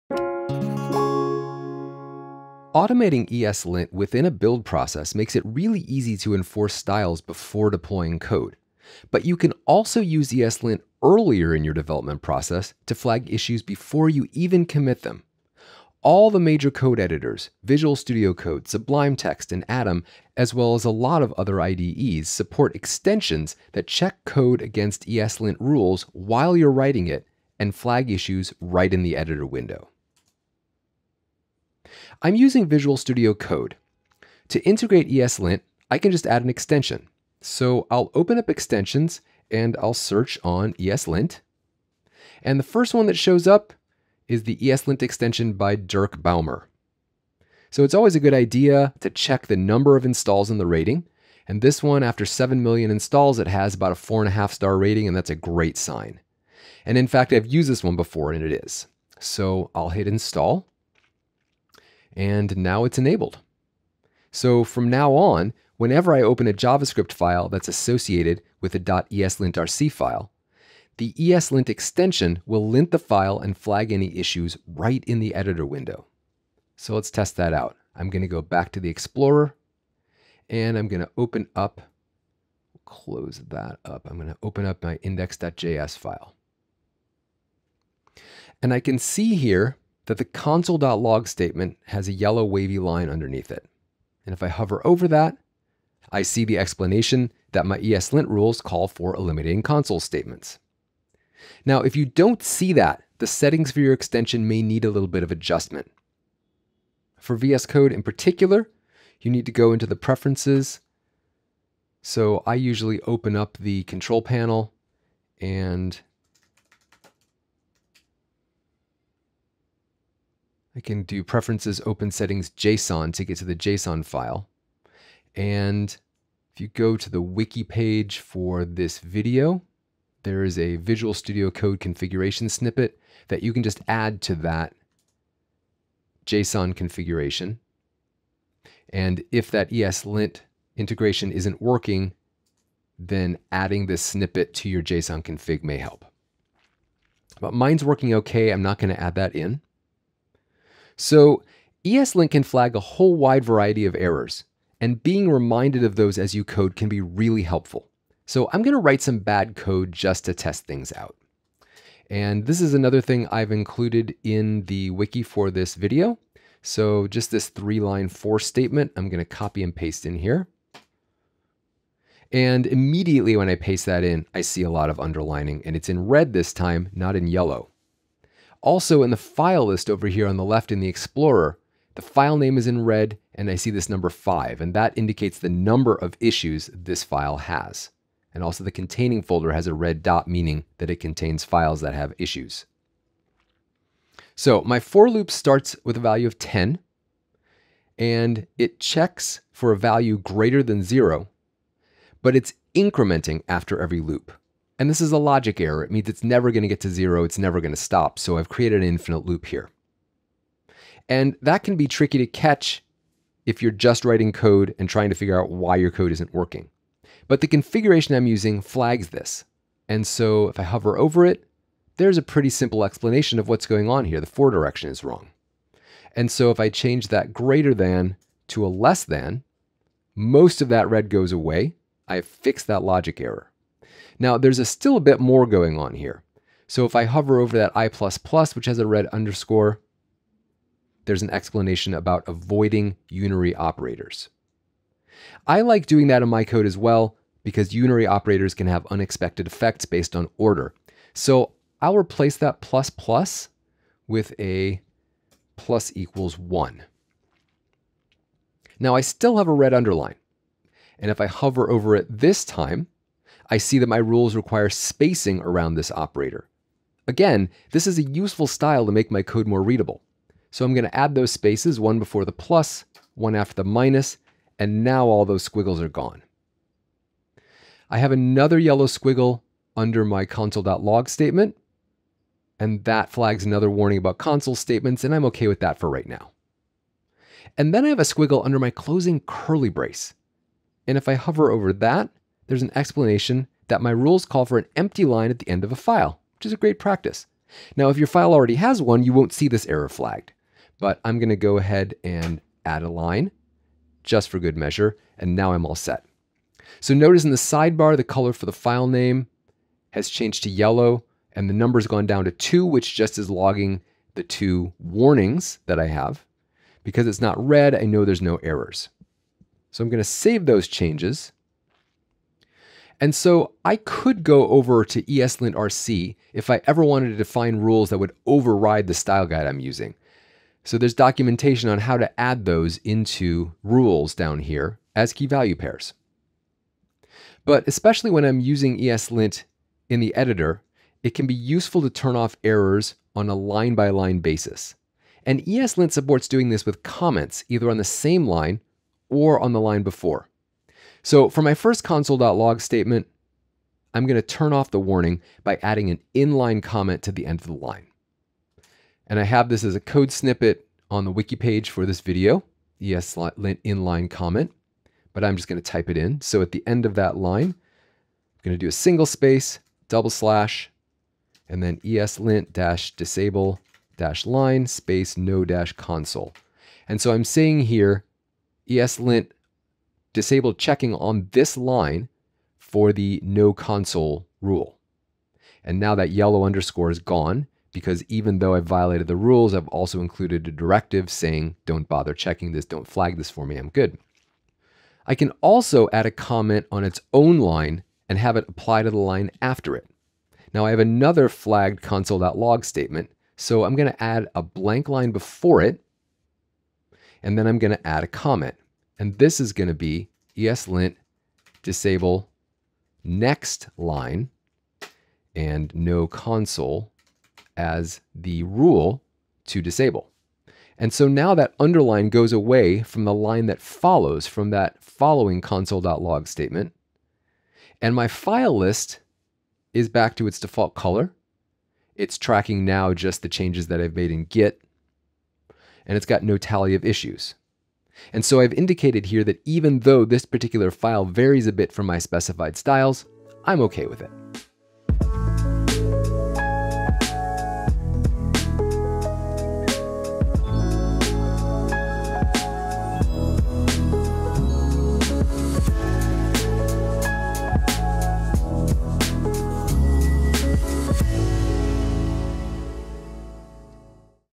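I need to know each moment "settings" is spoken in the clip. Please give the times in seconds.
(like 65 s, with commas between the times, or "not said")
103 s, 122 s.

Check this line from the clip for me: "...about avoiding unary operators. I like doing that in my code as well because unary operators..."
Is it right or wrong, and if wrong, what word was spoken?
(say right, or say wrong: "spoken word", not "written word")
right.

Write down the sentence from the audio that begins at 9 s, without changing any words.
But you can also use ESLint earlier in your development process to flag issues before you even commit them.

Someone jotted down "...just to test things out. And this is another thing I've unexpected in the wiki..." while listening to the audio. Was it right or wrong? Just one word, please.
wrong.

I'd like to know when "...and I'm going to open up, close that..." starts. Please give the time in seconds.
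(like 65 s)
80 s.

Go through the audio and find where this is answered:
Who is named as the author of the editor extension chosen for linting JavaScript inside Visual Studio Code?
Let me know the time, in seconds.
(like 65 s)
45 s.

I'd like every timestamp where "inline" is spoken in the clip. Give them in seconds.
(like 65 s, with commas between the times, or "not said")
356 s, 363 s.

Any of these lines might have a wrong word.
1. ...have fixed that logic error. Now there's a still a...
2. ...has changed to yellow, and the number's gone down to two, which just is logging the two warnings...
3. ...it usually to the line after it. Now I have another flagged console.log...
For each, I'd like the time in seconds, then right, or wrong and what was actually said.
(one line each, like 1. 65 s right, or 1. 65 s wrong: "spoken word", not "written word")
1. 232 s right
2. 309 s right
3. 398 s wrong: "apply", not "usually".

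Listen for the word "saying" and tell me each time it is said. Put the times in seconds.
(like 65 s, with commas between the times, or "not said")
377 s, 391 s.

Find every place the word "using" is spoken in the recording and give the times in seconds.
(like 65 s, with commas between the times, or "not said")
32 s, 218 s, 329 s, 338 s.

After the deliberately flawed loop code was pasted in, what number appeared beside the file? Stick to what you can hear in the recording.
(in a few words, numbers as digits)
5.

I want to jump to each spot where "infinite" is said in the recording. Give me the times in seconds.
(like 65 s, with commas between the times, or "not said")
208 s.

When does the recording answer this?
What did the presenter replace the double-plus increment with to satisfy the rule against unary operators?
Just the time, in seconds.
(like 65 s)
255 s.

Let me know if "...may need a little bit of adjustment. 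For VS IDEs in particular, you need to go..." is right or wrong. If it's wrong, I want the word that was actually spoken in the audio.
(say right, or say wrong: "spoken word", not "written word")
wrong: "Code", not "IDEs".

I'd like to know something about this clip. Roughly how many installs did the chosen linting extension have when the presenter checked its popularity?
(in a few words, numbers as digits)
7 million.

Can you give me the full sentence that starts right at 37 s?
So I'll open up extensions and I'll search on ESLint.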